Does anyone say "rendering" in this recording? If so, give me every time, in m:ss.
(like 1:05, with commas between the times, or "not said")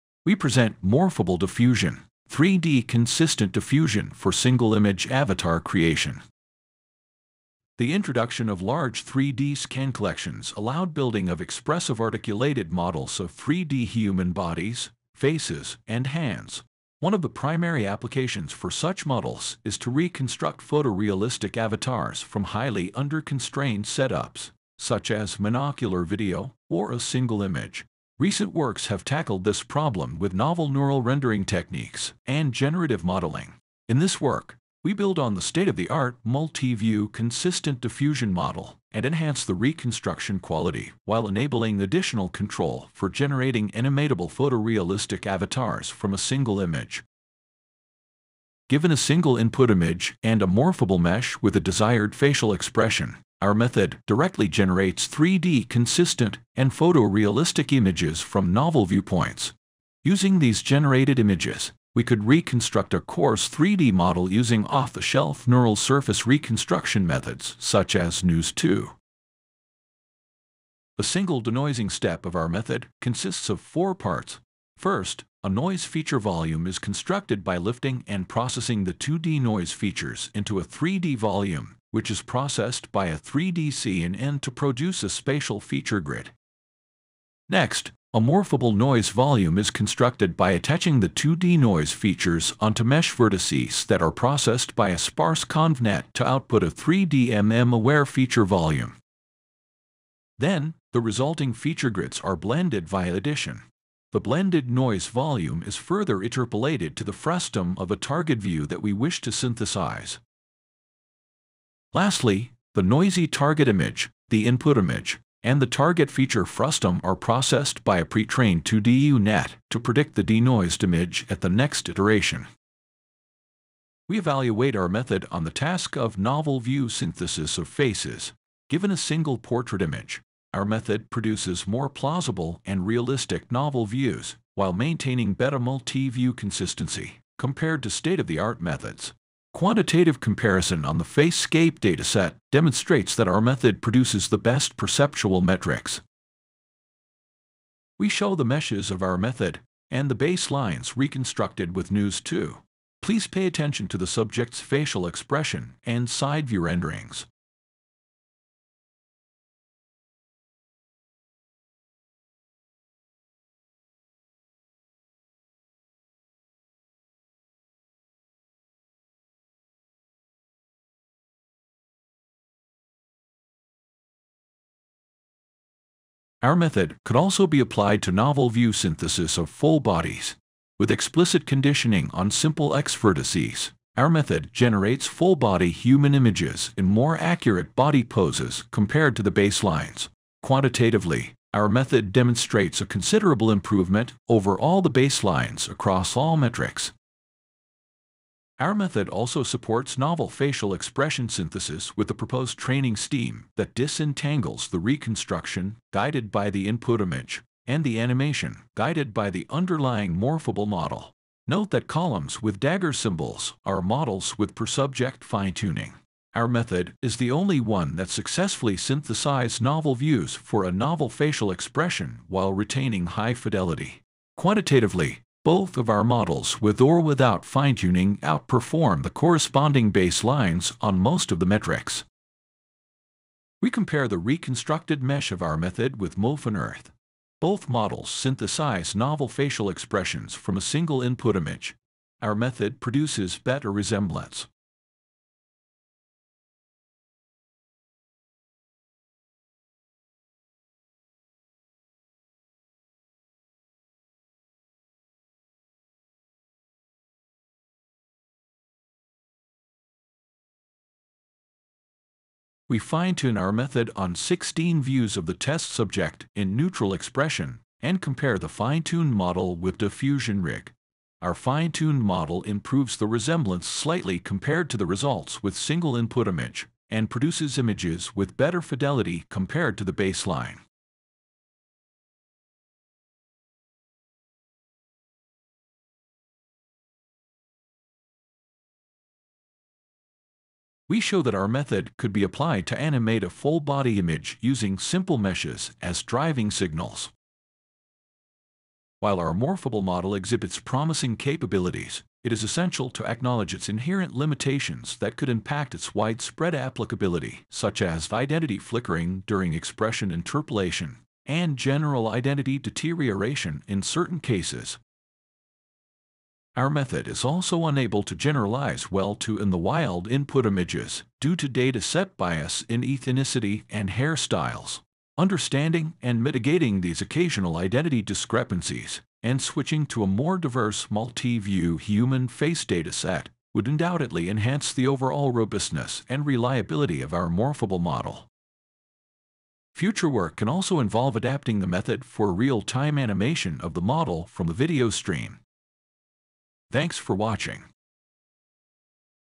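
0:31, 2:36.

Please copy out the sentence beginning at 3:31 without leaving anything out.
Note that columns with dagger symbols are models with per-subject fine-tuning.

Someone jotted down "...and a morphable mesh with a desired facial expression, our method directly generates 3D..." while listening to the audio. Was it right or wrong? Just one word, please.
right.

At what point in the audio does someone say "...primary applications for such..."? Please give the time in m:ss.
0:17.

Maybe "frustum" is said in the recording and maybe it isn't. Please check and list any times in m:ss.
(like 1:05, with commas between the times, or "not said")
1:47, 1:56.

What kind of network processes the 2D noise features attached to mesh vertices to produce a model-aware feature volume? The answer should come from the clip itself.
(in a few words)
sparse convnet.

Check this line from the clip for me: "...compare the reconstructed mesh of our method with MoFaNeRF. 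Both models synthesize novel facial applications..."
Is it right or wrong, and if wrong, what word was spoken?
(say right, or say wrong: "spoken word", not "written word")
wrong: "expressions", not "applications".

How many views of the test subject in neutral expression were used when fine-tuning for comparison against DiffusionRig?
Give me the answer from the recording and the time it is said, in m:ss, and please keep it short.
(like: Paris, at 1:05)
16, at 4:24.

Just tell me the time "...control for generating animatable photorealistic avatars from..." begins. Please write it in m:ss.
0:42.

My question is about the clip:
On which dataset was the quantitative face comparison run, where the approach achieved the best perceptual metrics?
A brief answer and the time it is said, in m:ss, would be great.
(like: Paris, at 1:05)
FaceScape, at 2:21.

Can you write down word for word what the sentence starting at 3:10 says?
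Quantitatively, our method demonstrates a considerable improvement over all the baselines across all metrics.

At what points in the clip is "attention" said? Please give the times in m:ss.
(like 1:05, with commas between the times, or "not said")
2:33.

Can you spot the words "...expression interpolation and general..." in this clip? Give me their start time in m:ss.
5:09.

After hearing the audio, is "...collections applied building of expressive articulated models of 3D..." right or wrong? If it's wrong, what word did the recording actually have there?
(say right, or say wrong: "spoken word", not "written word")
wrong: "allowed", not "applied".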